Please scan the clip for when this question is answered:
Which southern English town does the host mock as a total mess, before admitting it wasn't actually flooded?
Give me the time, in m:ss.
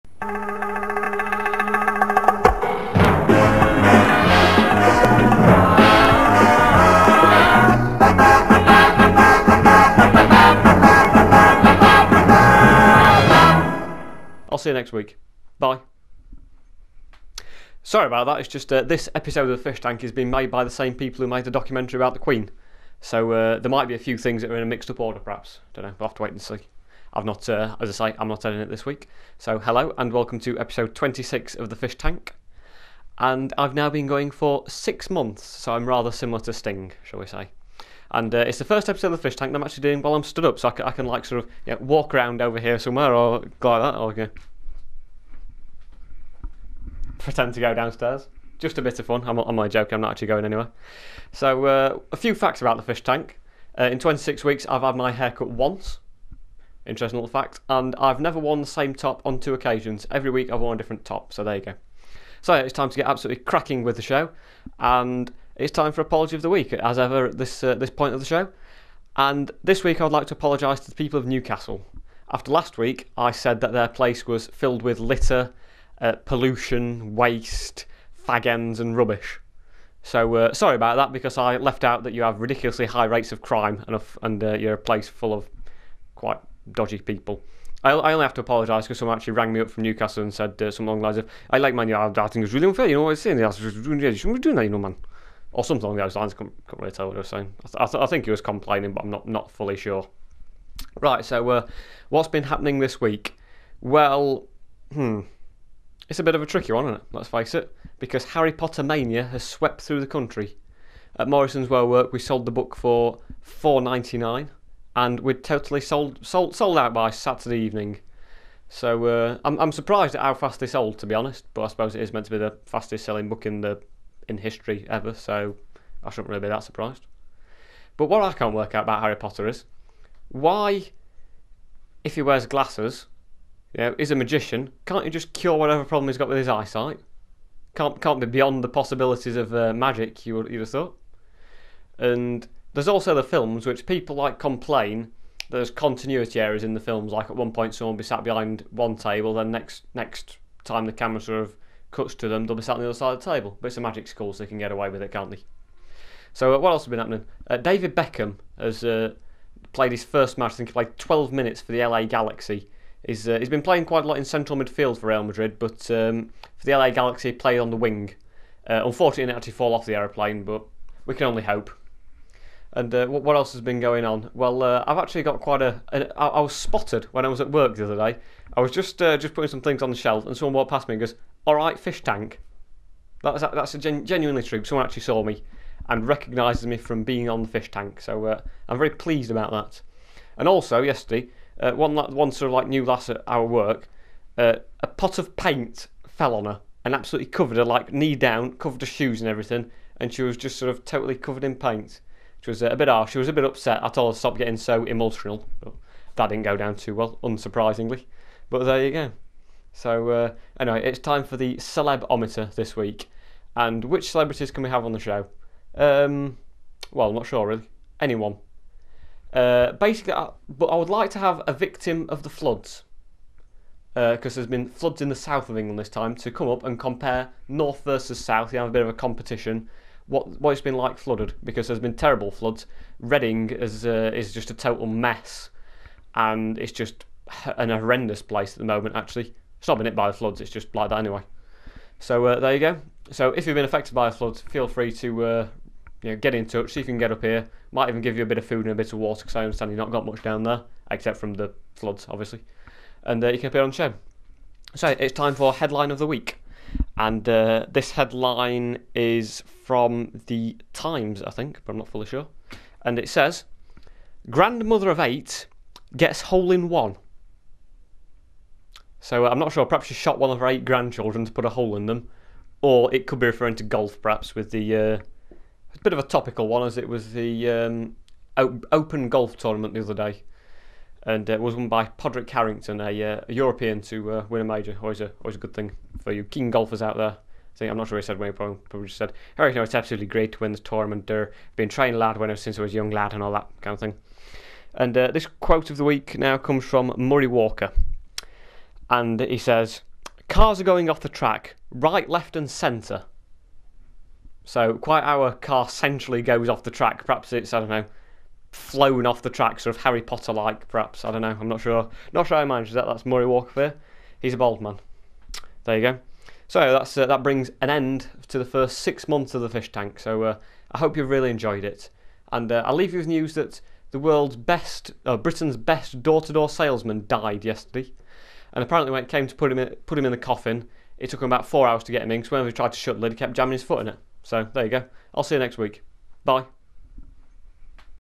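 3:52.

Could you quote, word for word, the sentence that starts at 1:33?
You shouldn't be doing that, you know, man.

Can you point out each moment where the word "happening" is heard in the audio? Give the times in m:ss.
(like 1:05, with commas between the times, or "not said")
1:42, 2:36.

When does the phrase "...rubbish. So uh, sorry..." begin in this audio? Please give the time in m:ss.
1:18.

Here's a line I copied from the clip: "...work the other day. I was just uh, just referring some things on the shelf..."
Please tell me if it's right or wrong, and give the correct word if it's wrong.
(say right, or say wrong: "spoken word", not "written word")
wrong: "putting", not "referring".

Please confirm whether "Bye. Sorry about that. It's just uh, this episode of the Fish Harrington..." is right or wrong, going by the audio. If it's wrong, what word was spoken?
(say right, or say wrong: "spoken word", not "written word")
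wrong: "Tank", not "Harrington".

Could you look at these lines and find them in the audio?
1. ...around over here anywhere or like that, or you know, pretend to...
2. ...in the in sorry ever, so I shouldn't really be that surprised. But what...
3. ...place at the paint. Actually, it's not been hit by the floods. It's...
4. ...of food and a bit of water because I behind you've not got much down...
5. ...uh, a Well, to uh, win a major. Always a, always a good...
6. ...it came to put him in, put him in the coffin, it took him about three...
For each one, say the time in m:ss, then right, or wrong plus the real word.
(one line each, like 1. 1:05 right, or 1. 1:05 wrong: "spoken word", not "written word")
1. 0:42 wrong: "somewhere", not "anywhere"
2. 2:03 wrong: "history", not "sorry"
3. 3:58 wrong: "moment", not "paint"
4. 4:08 wrong: "understand", not "behind"
5. 4:43 wrong: "European", not "Well"
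6. 5:29 wrong: "four", not "three".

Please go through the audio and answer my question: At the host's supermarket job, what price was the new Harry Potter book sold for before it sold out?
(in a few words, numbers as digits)
£4.99.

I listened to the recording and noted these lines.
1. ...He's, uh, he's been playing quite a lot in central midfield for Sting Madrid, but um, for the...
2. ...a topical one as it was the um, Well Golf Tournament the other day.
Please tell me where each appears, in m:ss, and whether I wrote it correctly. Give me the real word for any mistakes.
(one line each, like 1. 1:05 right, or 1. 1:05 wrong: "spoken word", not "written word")
1. 2:43 wrong: "Real", not "Sting"
2. 4:35 wrong: "Open", not "Well".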